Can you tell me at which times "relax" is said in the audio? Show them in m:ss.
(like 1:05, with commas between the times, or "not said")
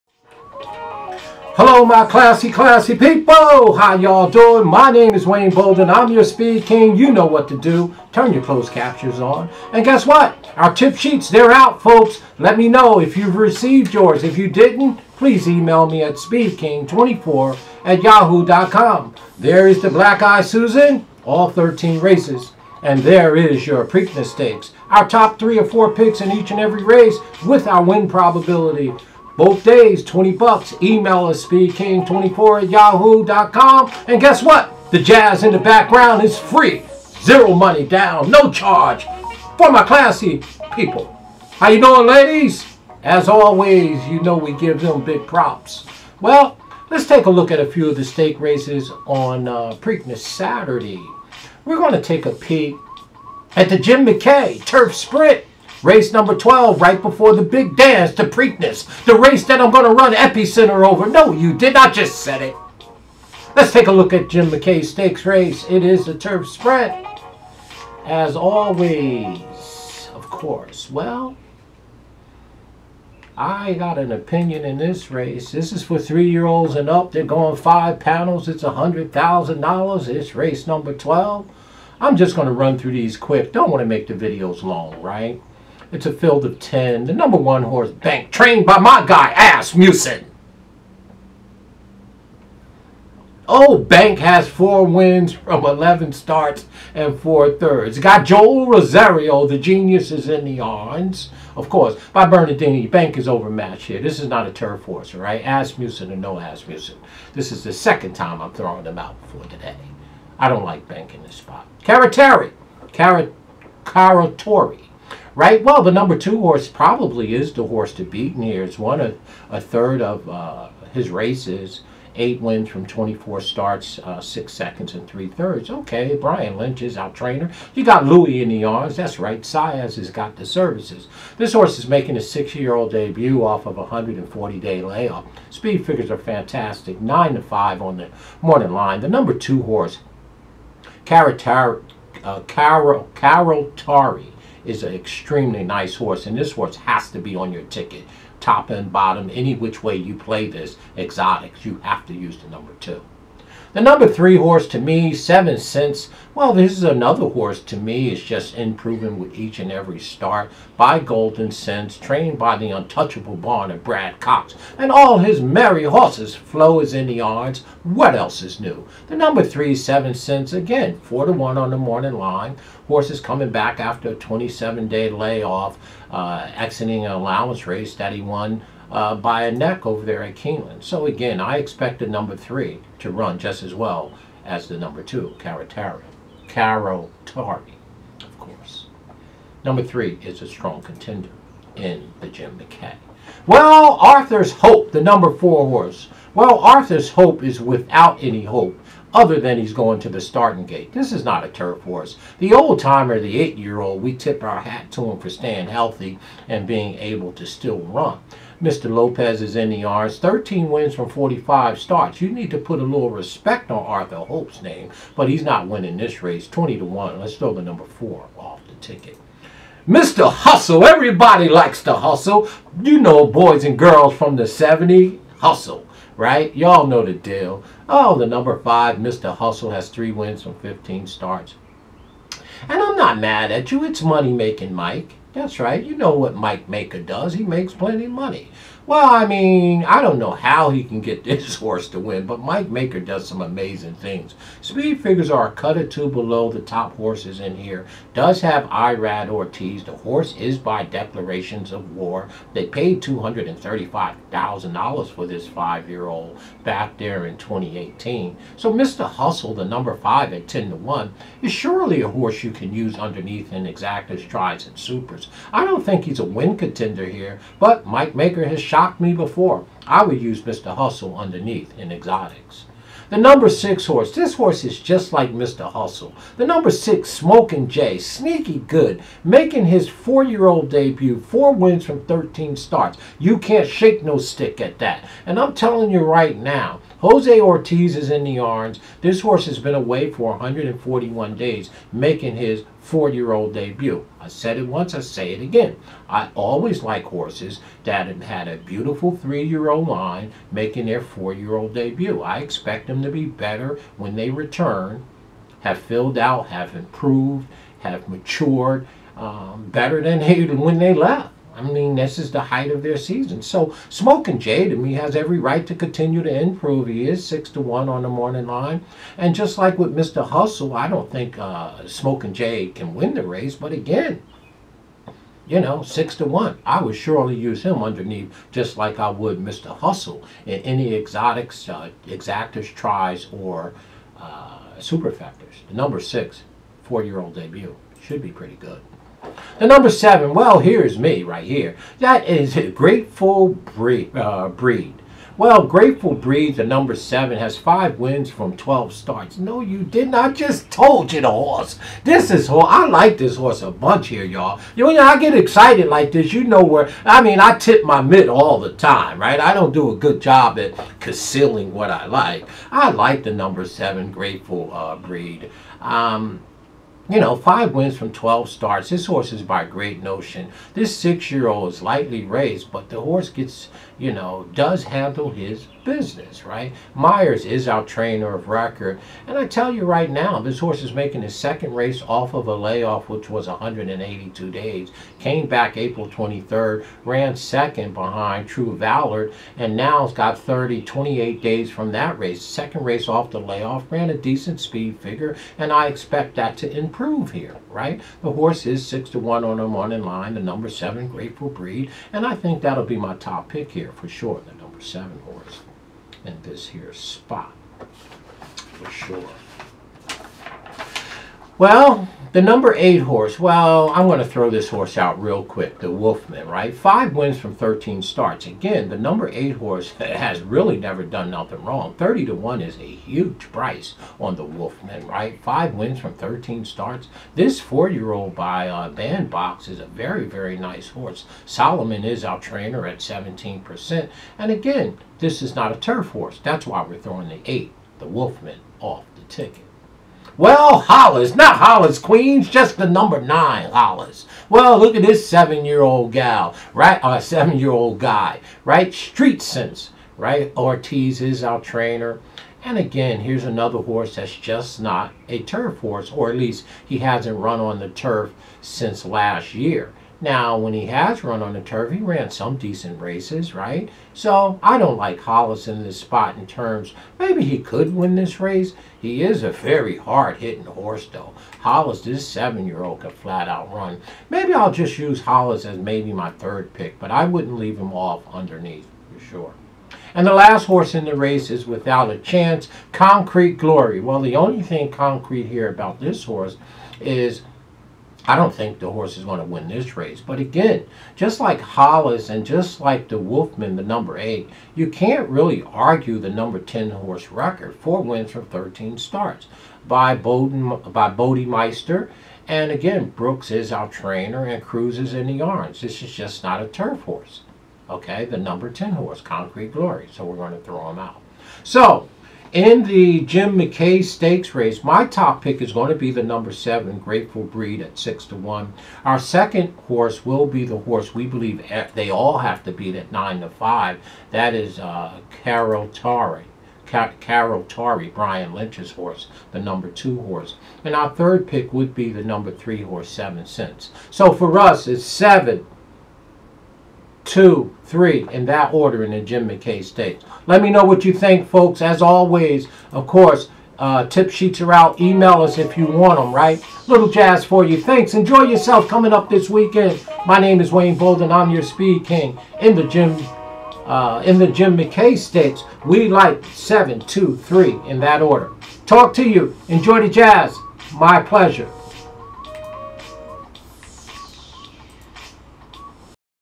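not said.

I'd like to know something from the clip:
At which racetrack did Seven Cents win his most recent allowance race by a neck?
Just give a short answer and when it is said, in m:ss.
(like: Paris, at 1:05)
Keeneland, at 3:00.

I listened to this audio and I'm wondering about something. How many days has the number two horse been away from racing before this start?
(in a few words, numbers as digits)
140.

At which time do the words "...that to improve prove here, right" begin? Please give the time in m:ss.
6:36.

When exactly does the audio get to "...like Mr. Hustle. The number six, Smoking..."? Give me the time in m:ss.
4:35.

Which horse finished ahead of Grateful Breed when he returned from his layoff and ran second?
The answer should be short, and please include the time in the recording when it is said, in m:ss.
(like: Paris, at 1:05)
True Valor, at 6:28.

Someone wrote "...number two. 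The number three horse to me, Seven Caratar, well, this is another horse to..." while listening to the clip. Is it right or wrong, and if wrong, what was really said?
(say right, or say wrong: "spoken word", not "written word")
wrong: "Cents", not "Caratar".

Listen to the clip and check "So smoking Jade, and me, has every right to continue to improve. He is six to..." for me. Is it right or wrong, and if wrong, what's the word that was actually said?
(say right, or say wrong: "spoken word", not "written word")
right.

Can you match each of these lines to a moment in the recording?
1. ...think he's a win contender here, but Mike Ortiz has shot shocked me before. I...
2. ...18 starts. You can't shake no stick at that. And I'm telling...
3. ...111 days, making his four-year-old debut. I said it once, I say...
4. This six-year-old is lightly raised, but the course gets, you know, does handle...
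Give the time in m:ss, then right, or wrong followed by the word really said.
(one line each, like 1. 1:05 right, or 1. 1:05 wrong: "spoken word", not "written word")
1. 4:25 wrong: "Maker", not "Ortiz"
2. 4:42 wrong: "13", not "18"
3. 4:50 wrong: "141", not "111"
4. 6:10 wrong: "horse", not "course".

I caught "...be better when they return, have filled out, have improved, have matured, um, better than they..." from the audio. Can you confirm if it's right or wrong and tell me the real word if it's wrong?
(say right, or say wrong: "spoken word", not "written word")
right.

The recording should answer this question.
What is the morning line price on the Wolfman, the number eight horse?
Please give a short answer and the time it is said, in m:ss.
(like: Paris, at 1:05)
30 to 1, at 7:01.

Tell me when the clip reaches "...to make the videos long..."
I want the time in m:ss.
1:23.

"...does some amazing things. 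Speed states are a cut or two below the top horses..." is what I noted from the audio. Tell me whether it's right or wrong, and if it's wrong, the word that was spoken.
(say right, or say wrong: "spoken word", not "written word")
wrong: "figures", not "states".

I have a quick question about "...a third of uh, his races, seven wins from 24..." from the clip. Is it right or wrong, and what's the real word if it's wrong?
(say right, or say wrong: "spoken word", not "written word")
wrong: "eight", not "seven".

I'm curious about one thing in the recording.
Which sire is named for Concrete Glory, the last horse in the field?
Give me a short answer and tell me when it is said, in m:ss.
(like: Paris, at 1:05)
Bodemeister, at 8:21.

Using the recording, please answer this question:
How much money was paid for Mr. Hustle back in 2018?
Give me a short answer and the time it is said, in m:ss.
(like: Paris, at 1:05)
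$235,000, at 4:13.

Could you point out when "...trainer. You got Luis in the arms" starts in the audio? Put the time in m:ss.
2:07.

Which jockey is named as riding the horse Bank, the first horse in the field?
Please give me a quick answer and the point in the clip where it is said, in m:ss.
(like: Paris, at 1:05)
Joel Rosario, at 1:38.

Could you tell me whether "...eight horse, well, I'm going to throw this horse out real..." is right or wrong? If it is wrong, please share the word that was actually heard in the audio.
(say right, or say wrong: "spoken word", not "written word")
right.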